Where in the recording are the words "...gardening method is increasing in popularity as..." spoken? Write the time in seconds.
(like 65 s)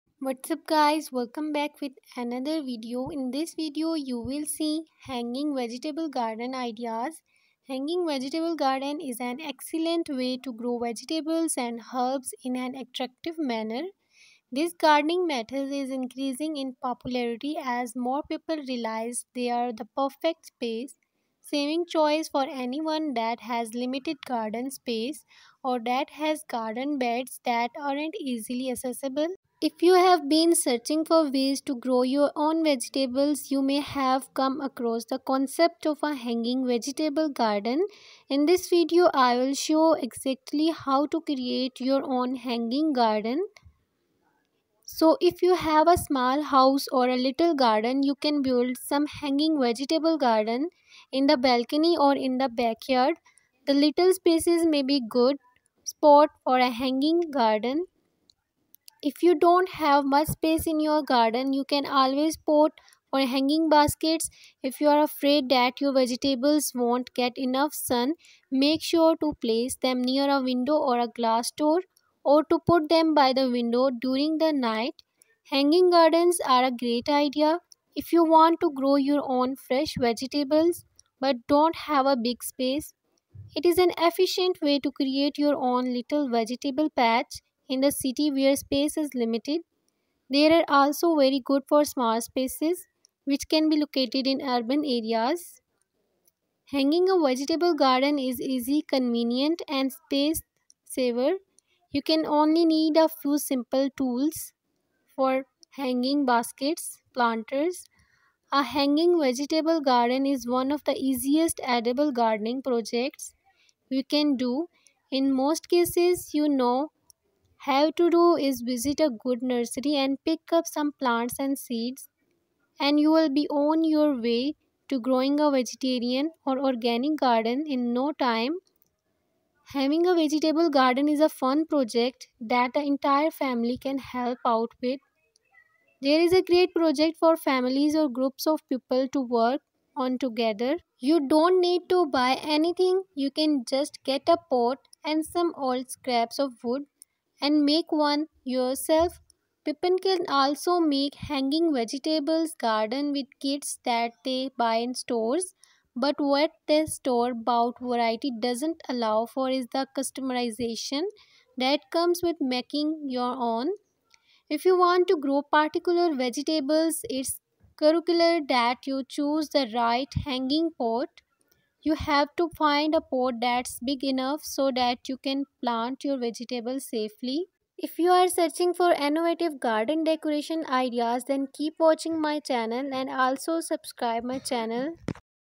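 14 s.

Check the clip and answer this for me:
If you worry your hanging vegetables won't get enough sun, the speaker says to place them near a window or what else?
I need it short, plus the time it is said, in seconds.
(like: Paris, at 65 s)
glass door, at 71 s.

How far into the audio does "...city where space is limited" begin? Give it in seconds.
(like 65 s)
87 s.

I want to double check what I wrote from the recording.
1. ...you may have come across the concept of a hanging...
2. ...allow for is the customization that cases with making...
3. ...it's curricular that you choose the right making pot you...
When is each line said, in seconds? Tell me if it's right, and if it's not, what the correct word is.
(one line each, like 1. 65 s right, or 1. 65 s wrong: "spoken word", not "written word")
1. 33 s right
2. 158 s wrong: "comes", not "cases"
3. 167 s wrong: "hanging", not "making".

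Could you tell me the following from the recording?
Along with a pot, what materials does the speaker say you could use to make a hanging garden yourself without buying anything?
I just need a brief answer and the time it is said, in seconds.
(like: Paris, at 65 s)
old scraps of wood, at 145 s.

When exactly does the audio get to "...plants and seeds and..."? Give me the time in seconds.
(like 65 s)
120 s.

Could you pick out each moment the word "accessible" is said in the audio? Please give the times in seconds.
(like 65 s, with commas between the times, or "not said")
28 s.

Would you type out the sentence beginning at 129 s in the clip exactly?
Having a vegetable garden is a fun project that the entire family can help out with.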